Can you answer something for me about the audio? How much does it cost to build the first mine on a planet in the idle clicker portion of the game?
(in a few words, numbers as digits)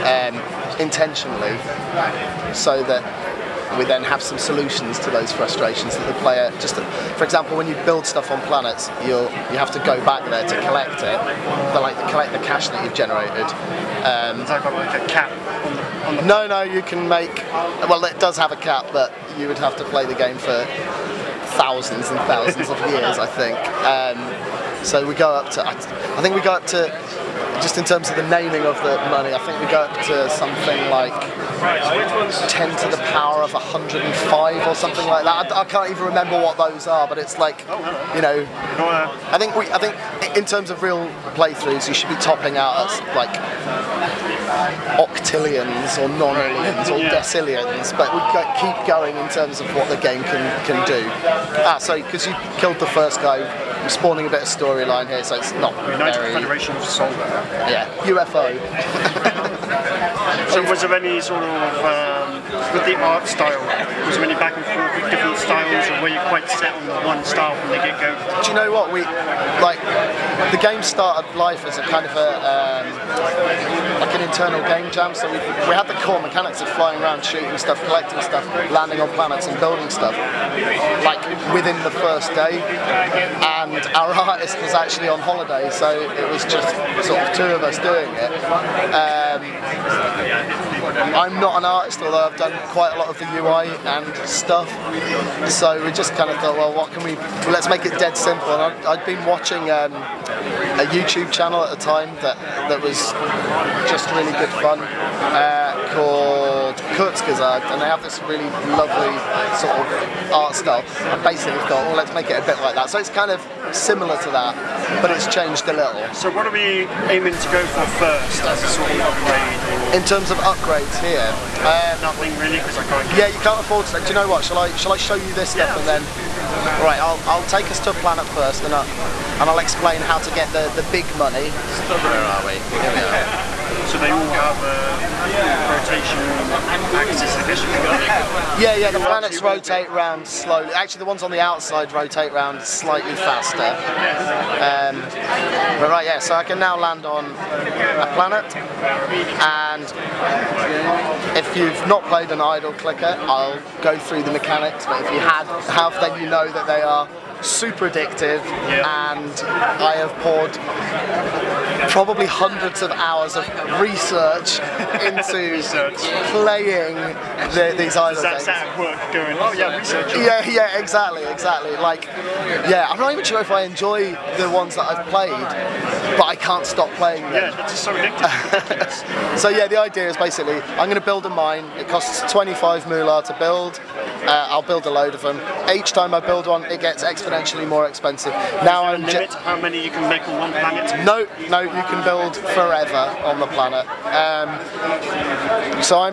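25 moolah.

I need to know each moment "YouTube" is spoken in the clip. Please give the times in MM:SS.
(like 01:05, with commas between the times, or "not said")
01:40.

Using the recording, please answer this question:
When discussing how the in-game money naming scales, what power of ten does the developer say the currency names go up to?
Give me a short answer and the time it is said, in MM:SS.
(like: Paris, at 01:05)
10 to the power of 105, at 00:32.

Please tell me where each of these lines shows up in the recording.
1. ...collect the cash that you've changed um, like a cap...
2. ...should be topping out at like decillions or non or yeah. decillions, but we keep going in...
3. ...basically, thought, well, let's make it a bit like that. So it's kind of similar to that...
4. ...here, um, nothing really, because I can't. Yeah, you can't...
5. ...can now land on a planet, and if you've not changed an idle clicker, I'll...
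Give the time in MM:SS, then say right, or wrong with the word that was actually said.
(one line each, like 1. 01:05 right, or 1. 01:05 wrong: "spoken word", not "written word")
1. 00:12 wrong: "generated", not "changed"
2. 00:41 wrong: "octillions", not "decillions"
3. 01:51 right
4. 02:00 right
5. 02:26 wrong: "played", not "changed".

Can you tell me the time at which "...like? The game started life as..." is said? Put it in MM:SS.
01:09.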